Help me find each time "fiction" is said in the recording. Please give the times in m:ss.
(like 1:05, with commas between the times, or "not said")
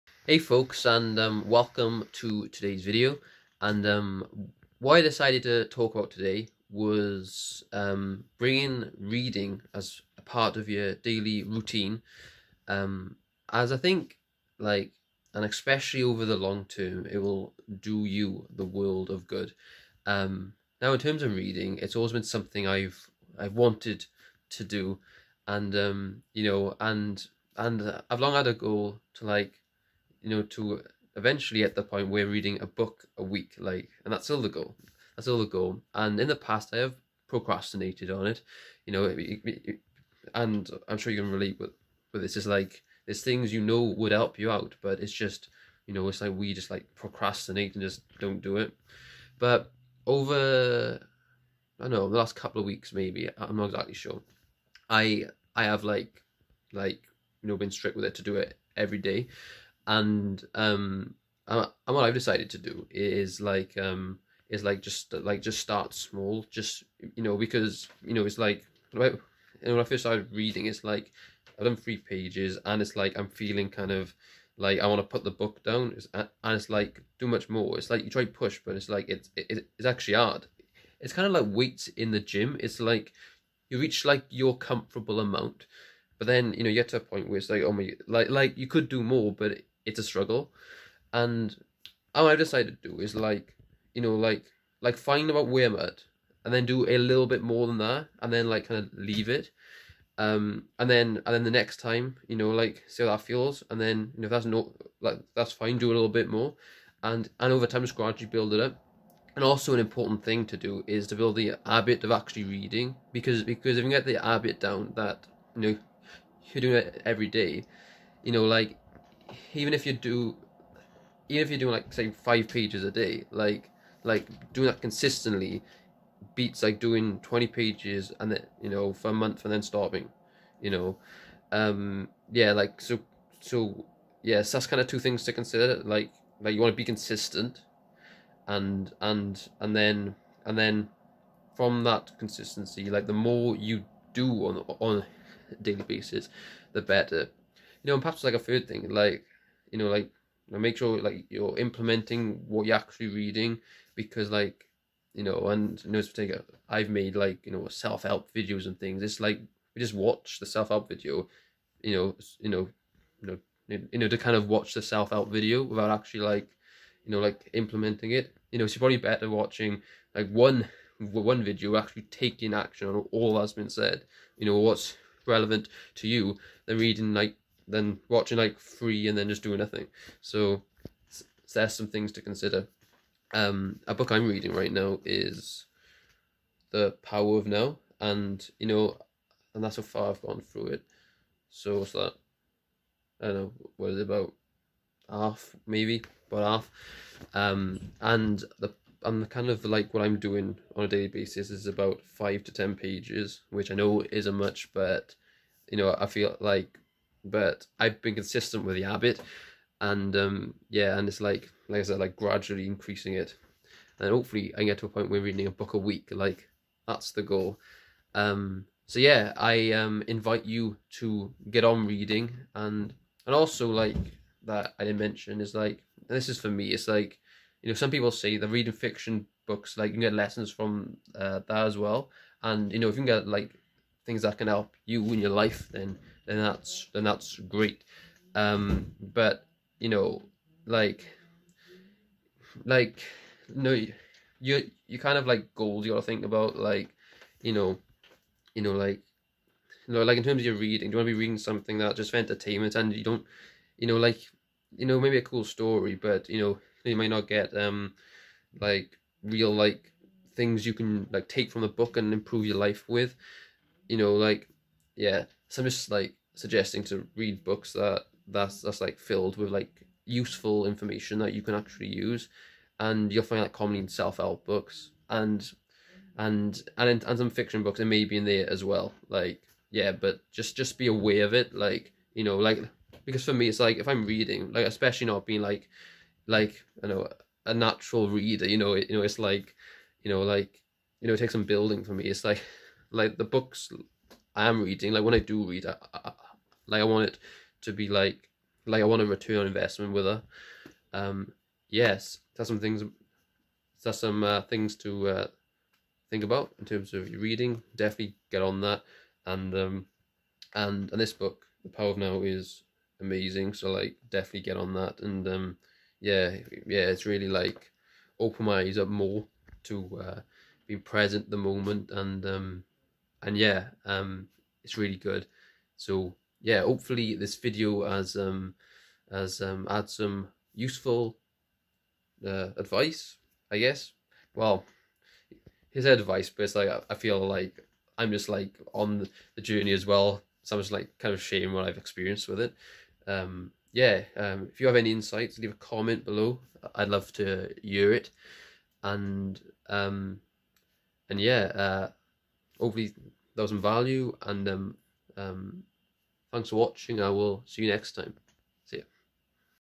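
3:48, 4:37.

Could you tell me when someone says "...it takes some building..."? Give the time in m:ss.
4:51.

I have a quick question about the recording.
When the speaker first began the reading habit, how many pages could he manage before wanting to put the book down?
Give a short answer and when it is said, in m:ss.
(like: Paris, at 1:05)
3, at 1:11.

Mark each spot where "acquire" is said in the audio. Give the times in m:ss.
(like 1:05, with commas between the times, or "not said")
not said.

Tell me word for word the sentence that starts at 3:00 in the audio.
So, so there's some things to consider.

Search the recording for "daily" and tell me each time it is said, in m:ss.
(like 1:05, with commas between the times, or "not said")
0:10, 2:25, 3:20.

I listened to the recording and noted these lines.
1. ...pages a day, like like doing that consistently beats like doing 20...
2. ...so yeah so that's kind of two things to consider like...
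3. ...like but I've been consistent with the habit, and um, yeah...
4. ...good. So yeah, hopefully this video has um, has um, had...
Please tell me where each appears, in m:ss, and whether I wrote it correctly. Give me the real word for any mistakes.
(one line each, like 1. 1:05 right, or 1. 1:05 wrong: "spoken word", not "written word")
1. 2:02 right
2. 2:13 right
3. 3:26 right
4. 5:24 right.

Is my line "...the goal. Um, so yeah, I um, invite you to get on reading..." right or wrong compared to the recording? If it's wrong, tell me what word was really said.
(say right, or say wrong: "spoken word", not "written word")
right.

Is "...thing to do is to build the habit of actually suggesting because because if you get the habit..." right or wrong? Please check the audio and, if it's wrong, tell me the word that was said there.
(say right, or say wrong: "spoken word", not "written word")
wrong: "reading", not "suggesting".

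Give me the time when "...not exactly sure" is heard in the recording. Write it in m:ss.
0:53.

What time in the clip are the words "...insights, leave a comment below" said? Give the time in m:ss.
5:44.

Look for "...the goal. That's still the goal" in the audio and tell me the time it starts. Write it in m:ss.
0:34.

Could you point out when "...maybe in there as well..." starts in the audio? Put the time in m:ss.
4:37.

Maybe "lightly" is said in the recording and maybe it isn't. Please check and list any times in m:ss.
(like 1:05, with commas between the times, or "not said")
not said.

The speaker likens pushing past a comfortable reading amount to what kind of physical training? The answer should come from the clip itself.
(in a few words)
Weights in the gym.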